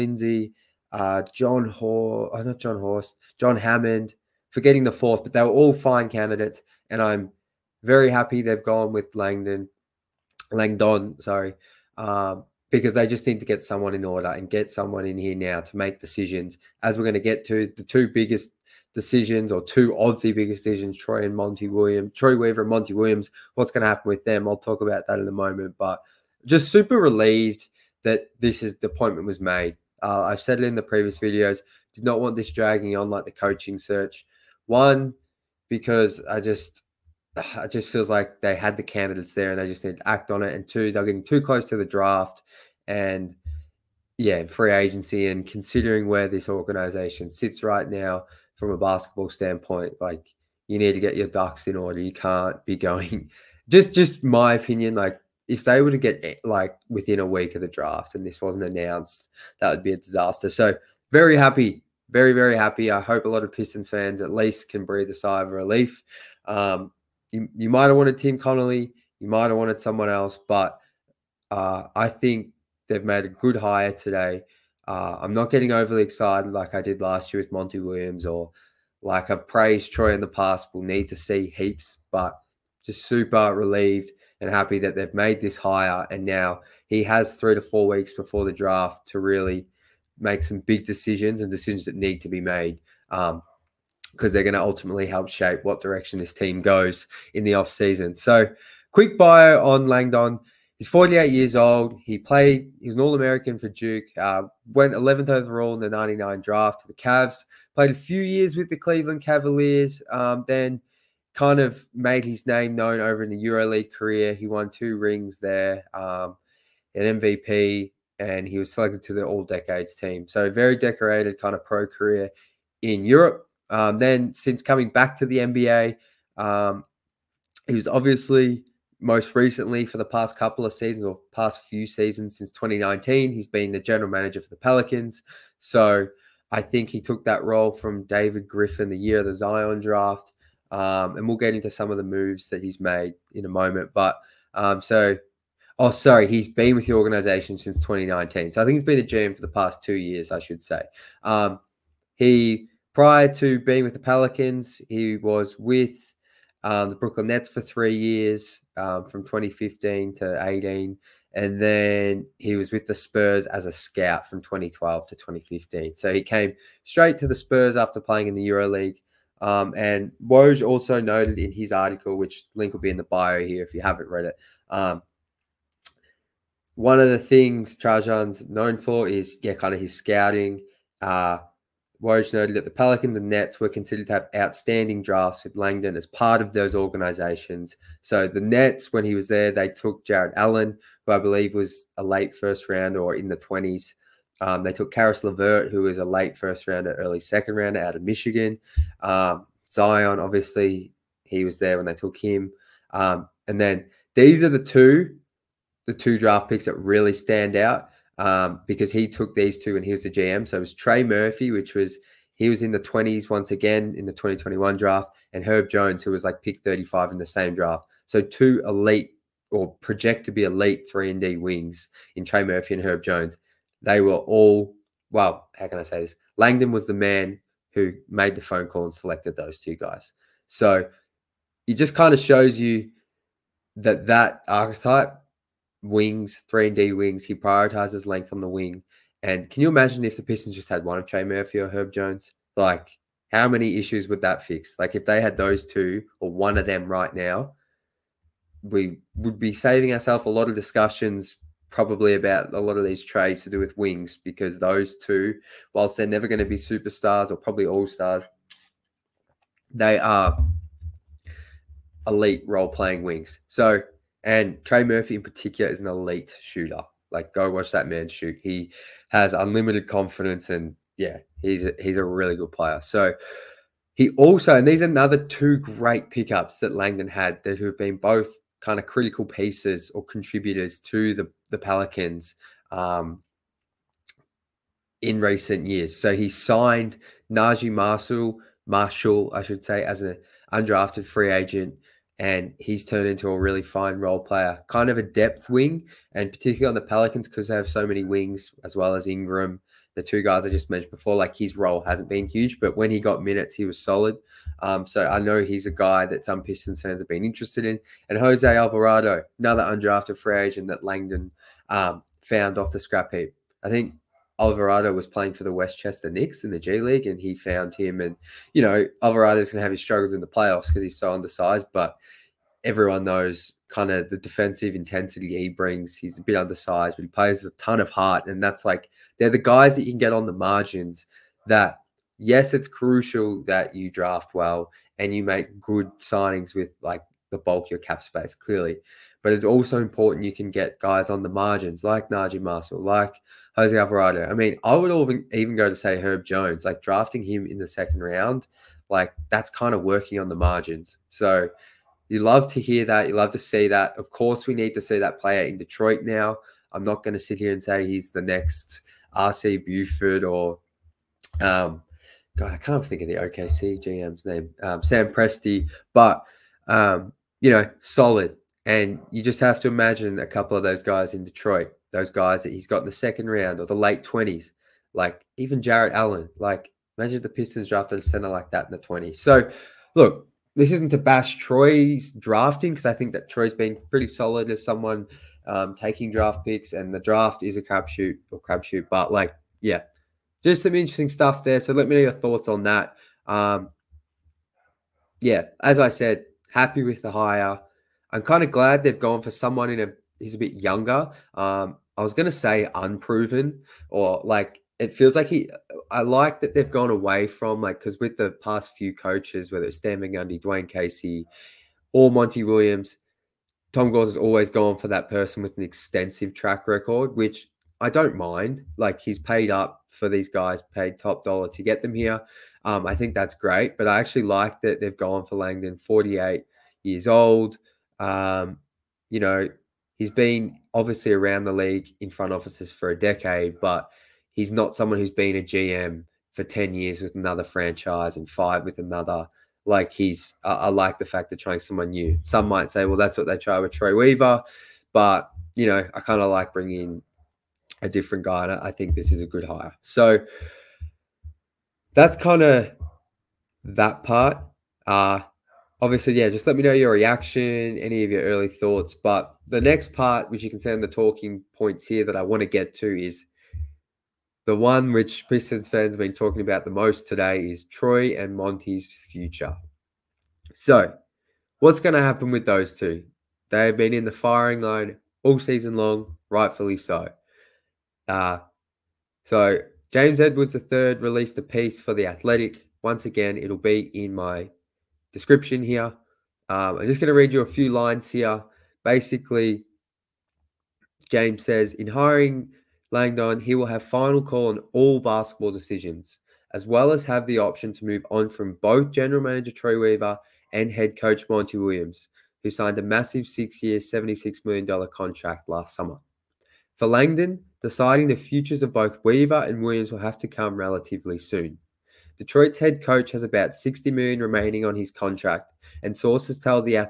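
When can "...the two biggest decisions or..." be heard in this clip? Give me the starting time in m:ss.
0:17.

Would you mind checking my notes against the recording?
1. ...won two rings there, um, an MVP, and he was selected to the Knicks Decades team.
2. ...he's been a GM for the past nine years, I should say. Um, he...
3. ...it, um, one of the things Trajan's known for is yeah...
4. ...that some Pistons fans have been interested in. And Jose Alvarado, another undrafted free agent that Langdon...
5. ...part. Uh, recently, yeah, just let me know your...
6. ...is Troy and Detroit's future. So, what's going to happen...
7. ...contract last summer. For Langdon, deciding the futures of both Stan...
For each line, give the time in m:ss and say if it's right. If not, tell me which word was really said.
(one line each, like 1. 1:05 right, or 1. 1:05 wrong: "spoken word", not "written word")
1. 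1:54 wrong: "All", not "Knicks"
2. 2:28 wrong: "two", not "nine"
3. 2:54 right
4. 5:06 right
5. 7:34 wrong: "obviously", not "recently"
6. 7:47 wrong: "Monty", not "Detroit"
7. 8:24 wrong: "Weaver", not "Stan".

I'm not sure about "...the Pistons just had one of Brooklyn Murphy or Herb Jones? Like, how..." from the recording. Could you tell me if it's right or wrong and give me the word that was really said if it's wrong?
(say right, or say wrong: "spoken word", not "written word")
wrong: "Trey", not "Brooklyn".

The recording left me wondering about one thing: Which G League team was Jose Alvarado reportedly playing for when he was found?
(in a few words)
Westchester Knicks.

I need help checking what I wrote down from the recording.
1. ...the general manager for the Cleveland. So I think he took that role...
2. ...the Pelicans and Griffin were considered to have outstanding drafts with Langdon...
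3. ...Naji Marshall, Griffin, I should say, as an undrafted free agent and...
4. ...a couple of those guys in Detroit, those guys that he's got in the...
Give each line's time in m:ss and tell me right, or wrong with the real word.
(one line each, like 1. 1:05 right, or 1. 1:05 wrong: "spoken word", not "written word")
1. 2:13 wrong: "Pelicans", not "Cleveland"
2. 3:02 wrong: "Nets", not "Griffin"
3. 4:47 wrong: "Marshall", not "Griffin"
4. 6:10 right.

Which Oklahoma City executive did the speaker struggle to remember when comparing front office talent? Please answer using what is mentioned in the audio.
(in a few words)
Sam Presti.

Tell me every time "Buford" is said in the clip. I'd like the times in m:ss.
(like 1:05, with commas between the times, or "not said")
5:59.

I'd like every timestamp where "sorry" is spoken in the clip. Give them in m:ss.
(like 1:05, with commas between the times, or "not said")
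0:11, 2:25.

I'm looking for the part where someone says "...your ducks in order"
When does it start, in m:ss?
0:51.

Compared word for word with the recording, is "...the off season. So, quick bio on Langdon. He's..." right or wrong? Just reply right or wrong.
right.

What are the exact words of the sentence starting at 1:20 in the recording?
We'll need to see heaps, but just super relieved and happy that they've made this hire.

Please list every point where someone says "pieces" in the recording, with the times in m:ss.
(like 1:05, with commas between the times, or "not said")
4:39, 8:01.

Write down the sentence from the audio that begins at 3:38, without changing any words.
So two elite or project to be elite three and D wings in Trey Murphy and Herb Jones.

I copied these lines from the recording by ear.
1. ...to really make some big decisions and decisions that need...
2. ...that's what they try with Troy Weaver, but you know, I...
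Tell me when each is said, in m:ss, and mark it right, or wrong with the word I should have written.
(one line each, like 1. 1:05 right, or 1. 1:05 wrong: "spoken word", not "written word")
1. 1:29 right
2. 7:22 right.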